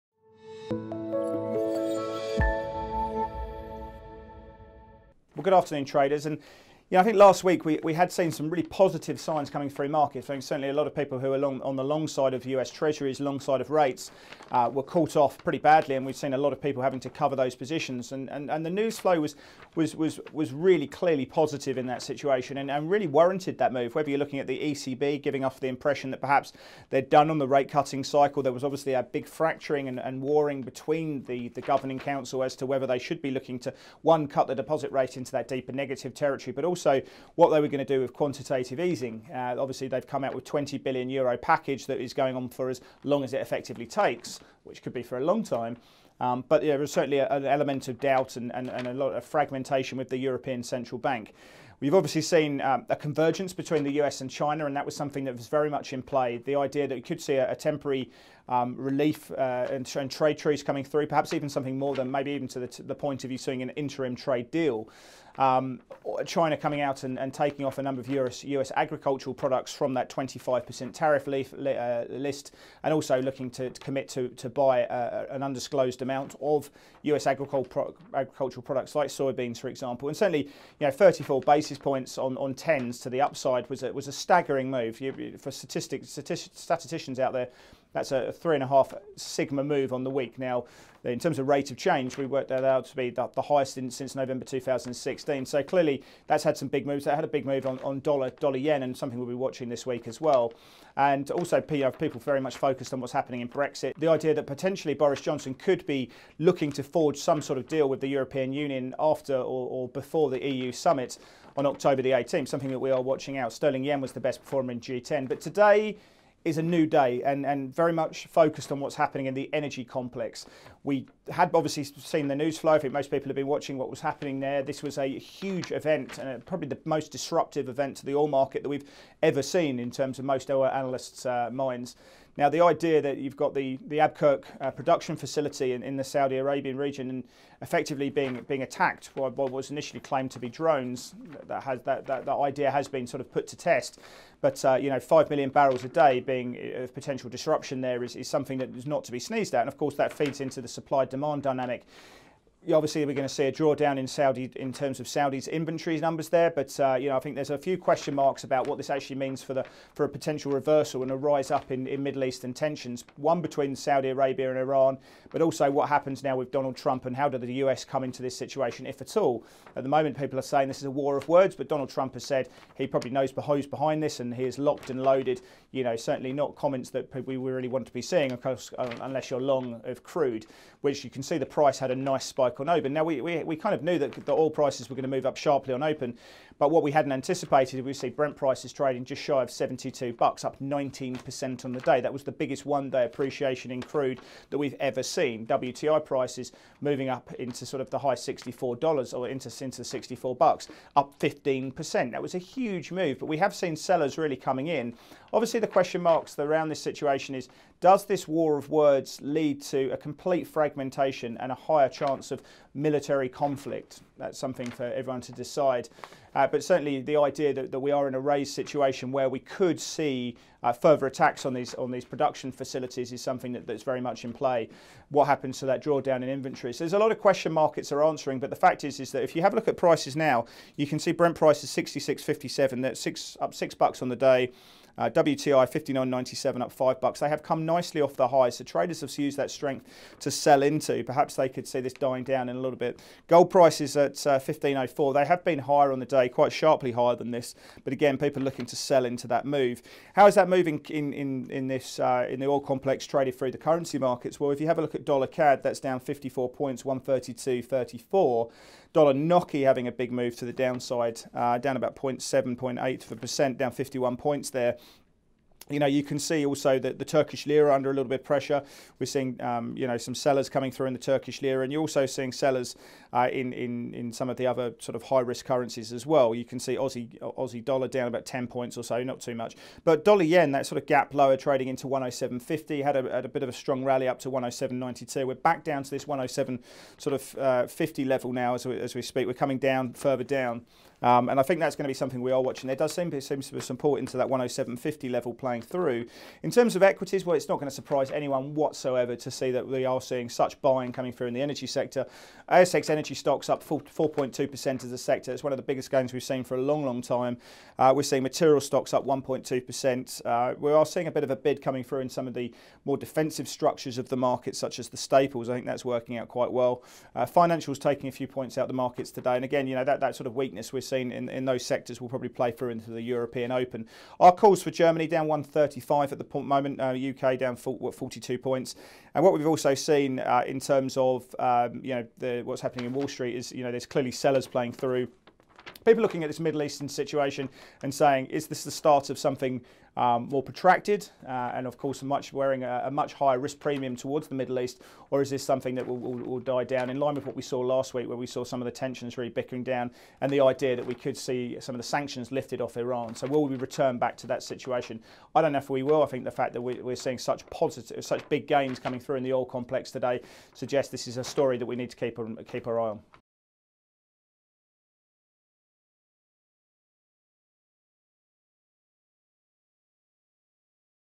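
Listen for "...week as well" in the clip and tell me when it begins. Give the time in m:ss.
1:39.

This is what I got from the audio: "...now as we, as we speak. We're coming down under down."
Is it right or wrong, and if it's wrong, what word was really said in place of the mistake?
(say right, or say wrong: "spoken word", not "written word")
wrong: "further", not "under".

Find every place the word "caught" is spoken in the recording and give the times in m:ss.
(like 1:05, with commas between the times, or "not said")
0:14.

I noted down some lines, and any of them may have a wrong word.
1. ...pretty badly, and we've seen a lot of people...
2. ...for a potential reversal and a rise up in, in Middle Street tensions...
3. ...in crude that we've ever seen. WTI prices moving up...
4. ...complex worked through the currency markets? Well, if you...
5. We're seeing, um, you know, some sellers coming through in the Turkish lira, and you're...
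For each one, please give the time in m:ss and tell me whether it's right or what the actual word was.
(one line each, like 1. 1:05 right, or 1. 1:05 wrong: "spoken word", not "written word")
1. 0:15 right
2. 2:39 wrong: "Eastern", not "Street"
3. 3:13 right
4. 4:12 wrong: "traded", not "worked"
5. 4:28 right.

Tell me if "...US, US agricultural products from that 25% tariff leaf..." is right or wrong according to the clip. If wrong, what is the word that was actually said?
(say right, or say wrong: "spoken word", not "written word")
right.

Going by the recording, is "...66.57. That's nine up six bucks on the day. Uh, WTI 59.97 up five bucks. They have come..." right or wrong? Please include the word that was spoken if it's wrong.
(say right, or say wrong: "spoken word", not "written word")
wrong: "six", not "nine".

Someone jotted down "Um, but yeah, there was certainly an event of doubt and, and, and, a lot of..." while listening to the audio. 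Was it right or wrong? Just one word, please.
wrong.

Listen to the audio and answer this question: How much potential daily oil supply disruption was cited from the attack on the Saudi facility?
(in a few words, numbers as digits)
5 million barrels a day.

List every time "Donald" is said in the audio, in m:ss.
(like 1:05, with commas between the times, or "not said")
2:46, 2:51.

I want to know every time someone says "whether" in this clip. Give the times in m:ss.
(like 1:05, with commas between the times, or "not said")
0:23, 0:32.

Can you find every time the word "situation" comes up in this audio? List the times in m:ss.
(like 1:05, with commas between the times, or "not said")
0:22, 2:48, 3:26, 3:38, 5:36, 5:54.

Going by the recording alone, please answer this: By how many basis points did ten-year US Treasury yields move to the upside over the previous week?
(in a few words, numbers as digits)
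34.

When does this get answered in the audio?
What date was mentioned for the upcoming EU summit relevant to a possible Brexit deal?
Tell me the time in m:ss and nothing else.
1:51.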